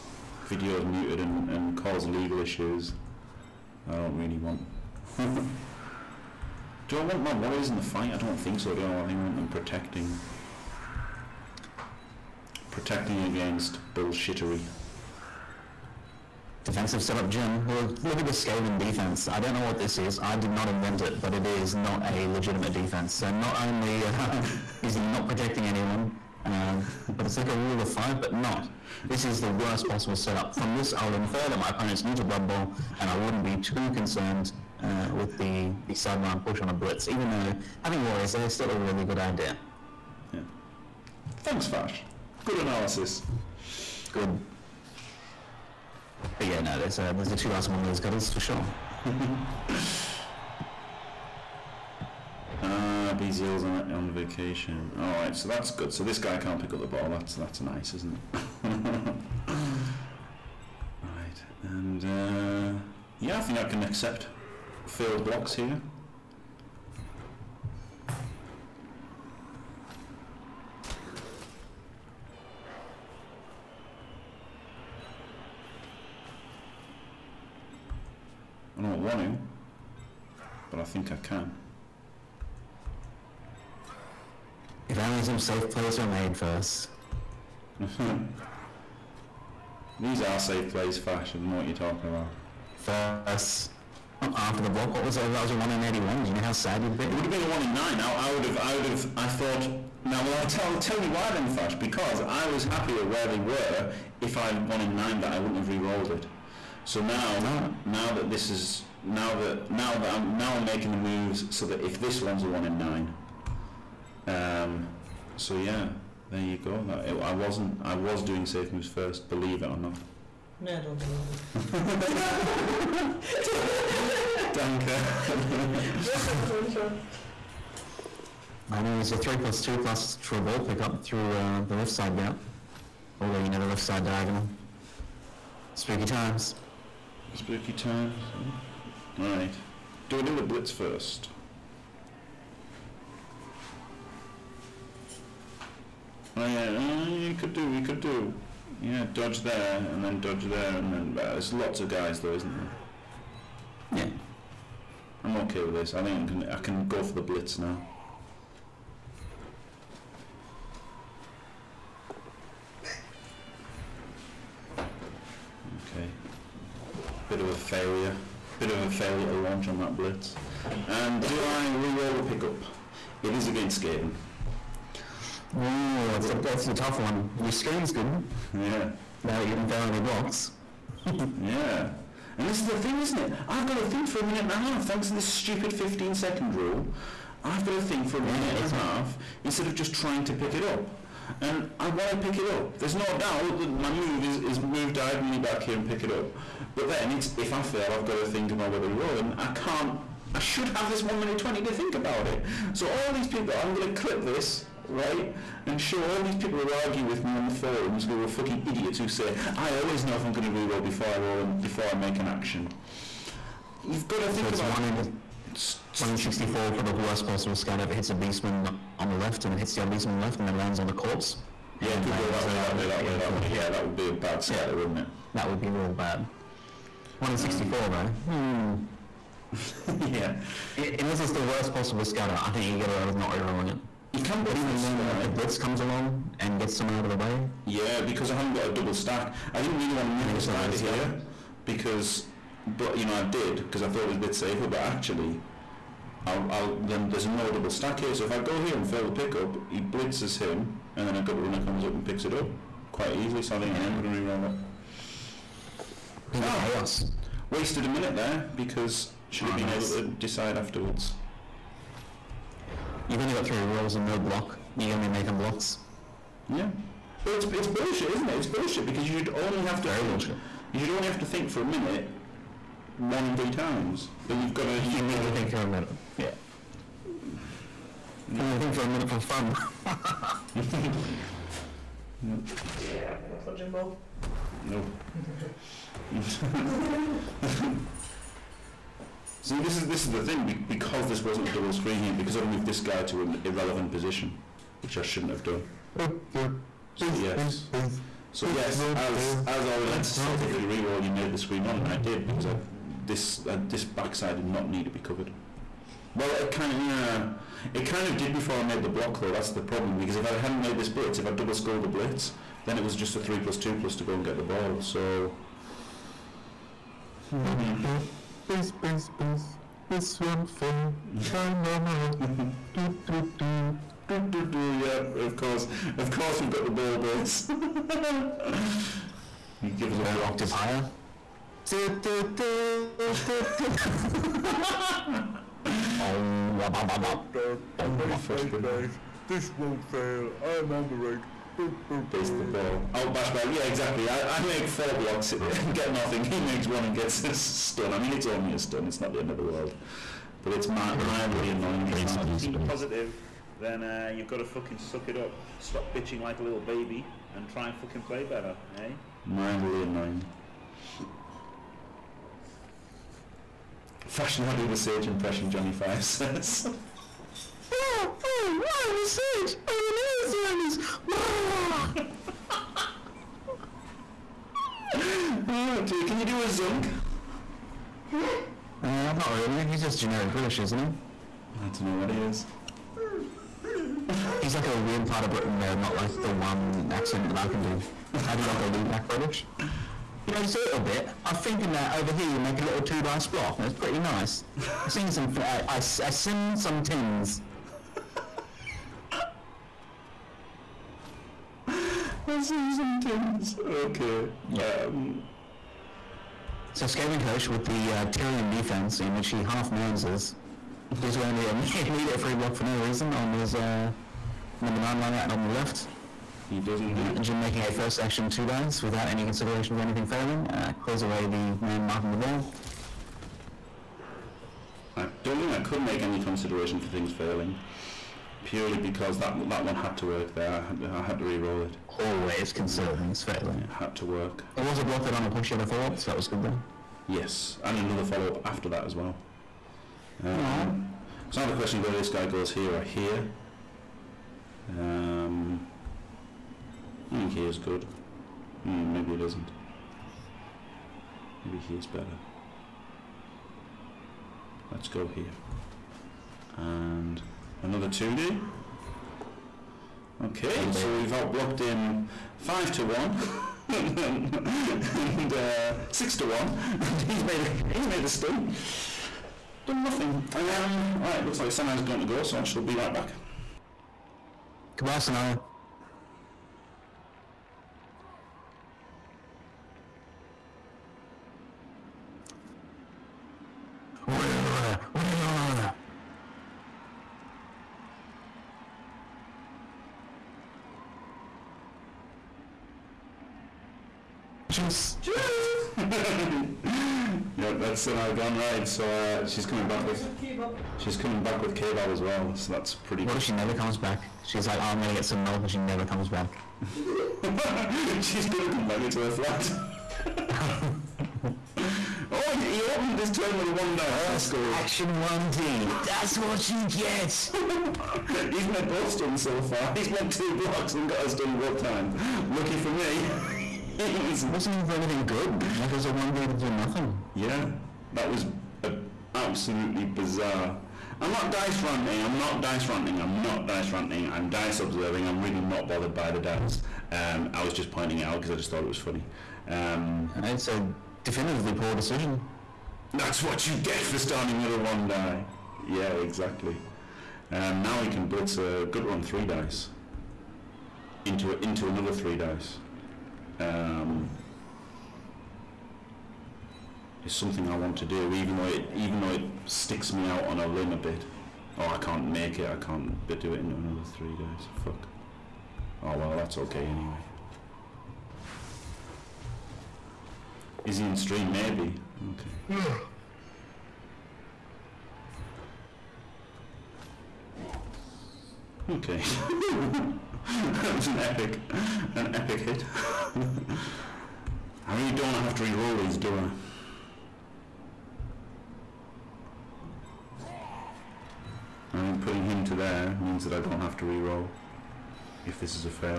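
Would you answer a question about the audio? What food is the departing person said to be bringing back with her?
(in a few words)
Kebab.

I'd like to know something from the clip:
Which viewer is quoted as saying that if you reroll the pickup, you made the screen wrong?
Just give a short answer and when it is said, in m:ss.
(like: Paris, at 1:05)
Orilentis, at 4:59.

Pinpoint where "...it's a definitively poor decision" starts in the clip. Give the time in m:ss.
9:00.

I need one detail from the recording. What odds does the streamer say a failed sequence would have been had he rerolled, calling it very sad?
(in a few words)
1 in 81.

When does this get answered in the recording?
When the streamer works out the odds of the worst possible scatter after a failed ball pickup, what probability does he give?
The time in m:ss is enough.
3:35.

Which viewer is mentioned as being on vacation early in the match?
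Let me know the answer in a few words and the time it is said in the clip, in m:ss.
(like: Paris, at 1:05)
BZL, at 0:53.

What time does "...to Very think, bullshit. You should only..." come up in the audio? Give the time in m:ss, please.
4:29.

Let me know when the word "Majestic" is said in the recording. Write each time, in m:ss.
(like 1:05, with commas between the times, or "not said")
not said.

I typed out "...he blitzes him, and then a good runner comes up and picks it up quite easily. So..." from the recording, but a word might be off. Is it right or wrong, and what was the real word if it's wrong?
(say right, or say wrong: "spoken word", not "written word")
right.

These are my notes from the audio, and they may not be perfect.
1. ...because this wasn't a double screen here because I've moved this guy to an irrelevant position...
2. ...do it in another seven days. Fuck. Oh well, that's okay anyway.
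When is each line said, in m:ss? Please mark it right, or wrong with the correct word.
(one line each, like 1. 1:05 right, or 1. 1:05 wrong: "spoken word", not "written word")
1. 4:50 right
2. 9:23 wrong: "three", not "seven".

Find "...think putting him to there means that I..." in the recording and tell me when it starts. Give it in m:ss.
9:51.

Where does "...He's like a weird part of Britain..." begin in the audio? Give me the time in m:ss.
6:24.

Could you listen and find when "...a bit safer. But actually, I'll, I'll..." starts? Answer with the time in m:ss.
4:04.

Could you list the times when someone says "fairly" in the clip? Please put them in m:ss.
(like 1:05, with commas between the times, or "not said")
7:13.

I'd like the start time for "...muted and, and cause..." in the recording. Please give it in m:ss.
0:00.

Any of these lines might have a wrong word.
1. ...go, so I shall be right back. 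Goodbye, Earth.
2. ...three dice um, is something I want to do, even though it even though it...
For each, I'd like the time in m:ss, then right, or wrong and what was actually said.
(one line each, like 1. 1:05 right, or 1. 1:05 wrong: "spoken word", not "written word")
1. 7:52 wrong: "Senai", not "Earth"
2. 9:11 right.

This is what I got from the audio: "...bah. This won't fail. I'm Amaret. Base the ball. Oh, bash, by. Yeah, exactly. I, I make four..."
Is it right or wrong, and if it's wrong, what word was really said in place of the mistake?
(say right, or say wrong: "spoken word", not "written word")
right.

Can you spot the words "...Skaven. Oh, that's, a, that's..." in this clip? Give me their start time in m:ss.
2:53.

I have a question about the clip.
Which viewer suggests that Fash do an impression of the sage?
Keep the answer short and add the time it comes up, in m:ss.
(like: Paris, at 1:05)
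Johnny Five, at 6:05.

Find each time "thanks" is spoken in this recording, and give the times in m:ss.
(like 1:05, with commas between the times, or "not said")
0:41, 3:04.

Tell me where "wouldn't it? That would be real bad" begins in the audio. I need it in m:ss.
3:44.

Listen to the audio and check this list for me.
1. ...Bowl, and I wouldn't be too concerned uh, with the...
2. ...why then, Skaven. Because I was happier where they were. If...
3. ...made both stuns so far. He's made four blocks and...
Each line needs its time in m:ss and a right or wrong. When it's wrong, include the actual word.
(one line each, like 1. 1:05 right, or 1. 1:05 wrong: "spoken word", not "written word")
1. 0:32 right
2. 1:41 wrong: "Fash", not "Skaven"
3. 8:38 wrong: "two", not "four".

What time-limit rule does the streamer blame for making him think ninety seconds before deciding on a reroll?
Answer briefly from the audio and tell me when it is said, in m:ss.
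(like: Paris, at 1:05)
15 second rule, at 3:05.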